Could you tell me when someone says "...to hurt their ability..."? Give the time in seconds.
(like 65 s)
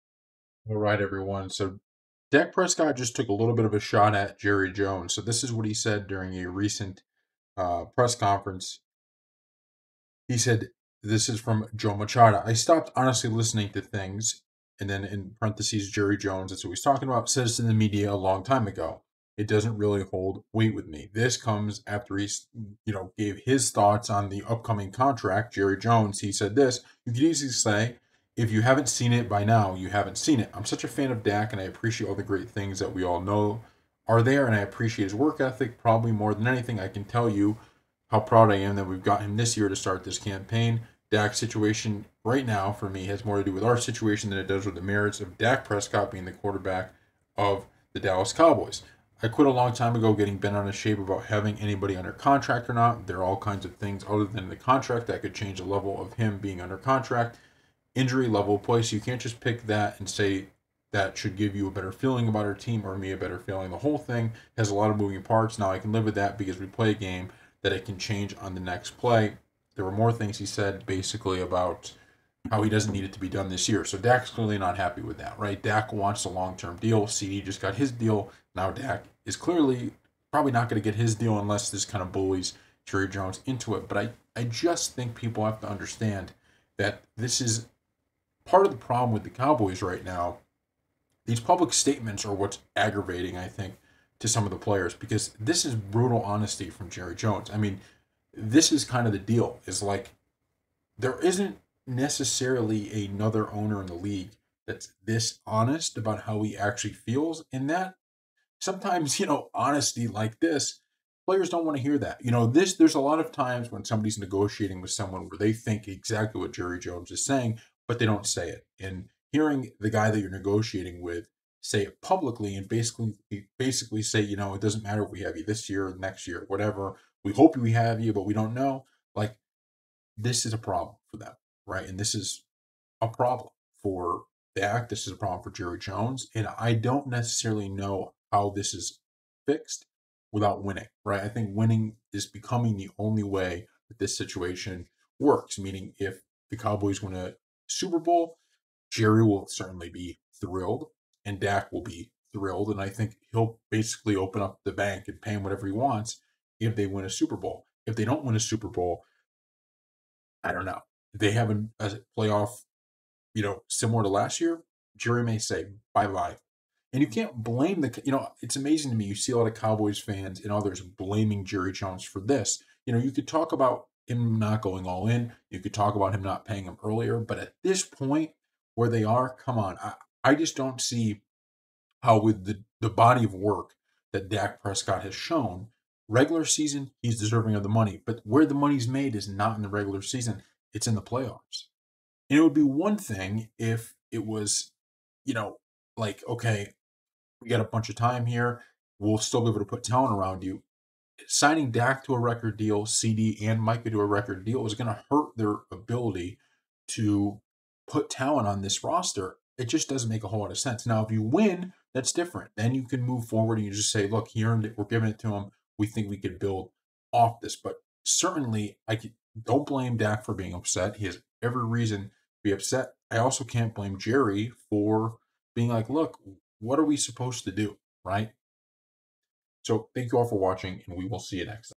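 204 s.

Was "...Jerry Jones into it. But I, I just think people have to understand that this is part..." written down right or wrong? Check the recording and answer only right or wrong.
right.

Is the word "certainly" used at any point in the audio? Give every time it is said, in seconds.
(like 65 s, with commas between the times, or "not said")
149 s, 218 s.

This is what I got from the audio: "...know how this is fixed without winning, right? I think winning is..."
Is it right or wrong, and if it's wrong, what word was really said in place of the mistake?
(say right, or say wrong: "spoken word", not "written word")
right.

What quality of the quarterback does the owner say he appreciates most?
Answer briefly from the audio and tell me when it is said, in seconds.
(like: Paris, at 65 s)
work ethic, at 35 s.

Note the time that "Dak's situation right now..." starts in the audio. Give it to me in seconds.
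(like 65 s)
41 s.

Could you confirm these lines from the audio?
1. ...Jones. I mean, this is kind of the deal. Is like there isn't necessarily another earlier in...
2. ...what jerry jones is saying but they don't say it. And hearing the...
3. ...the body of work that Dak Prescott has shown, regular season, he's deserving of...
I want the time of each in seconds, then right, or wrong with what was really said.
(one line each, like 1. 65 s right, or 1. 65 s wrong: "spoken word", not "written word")
1. 97 s wrong: "owner", not "earlier"
2. 116 s right
3. 182 s right.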